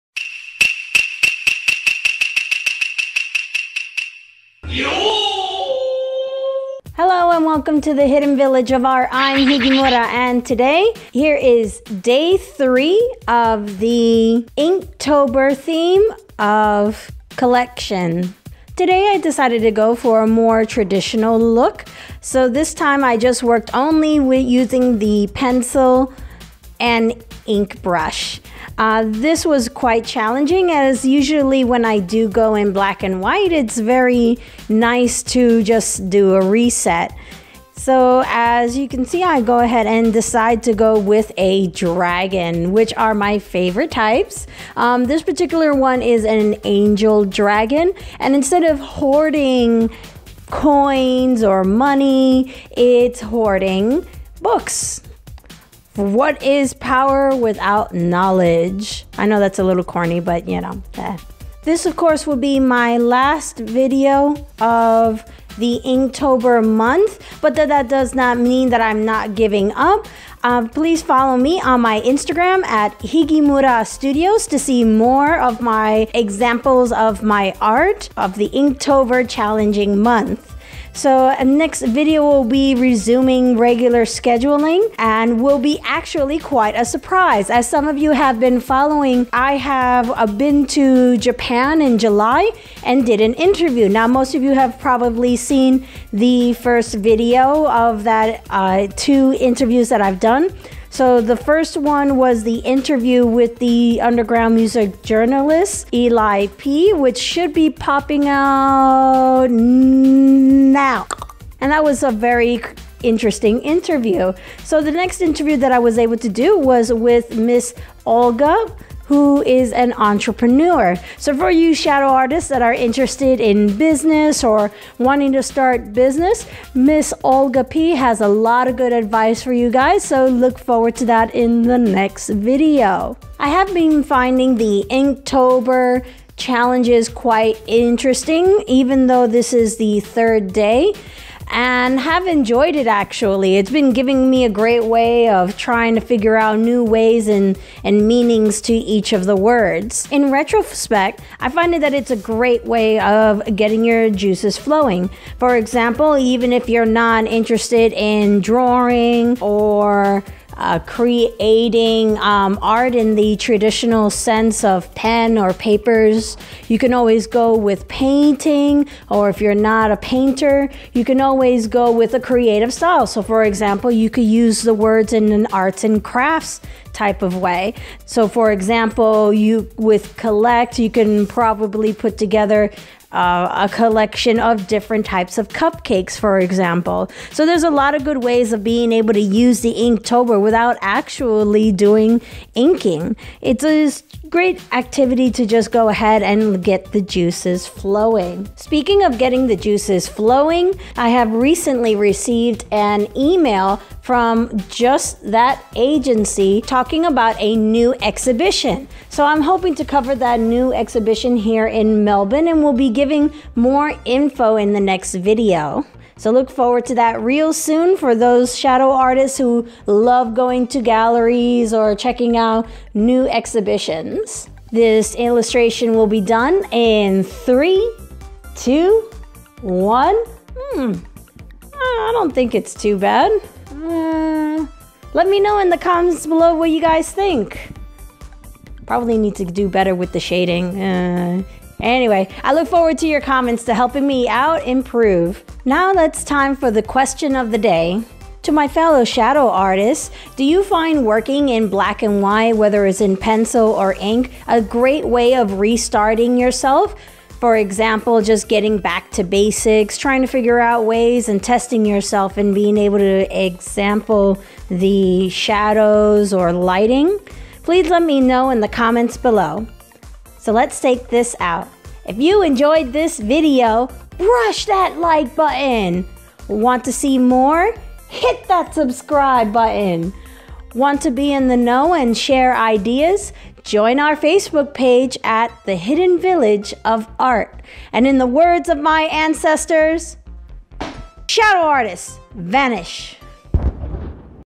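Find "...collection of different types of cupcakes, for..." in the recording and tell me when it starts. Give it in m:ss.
3:03.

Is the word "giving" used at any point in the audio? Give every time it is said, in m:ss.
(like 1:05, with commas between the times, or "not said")
1:09, 2:23, 3:32.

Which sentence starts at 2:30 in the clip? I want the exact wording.
In retrospect, I find that it's a great way of getting your juices flowing.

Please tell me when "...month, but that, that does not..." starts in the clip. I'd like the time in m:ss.
1:06.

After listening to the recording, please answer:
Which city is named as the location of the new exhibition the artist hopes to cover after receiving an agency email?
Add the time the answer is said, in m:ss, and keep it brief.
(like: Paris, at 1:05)
Melbourne, at 3:32.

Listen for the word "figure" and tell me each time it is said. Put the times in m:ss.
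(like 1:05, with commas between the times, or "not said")
2:26, 4:20.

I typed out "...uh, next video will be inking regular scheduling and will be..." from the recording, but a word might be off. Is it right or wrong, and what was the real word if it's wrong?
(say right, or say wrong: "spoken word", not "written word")
wrong: "resuming", not "inking".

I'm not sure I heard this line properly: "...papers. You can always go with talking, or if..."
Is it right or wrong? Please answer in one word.
wrong.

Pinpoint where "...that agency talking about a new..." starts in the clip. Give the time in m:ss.
3:25.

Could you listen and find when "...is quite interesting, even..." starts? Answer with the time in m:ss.
2:16.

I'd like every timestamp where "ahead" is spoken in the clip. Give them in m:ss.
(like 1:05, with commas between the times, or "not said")
0:39, 3:15.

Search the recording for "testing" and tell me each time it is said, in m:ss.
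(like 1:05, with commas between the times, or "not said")
4:21.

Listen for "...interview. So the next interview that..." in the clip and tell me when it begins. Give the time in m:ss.
1:53.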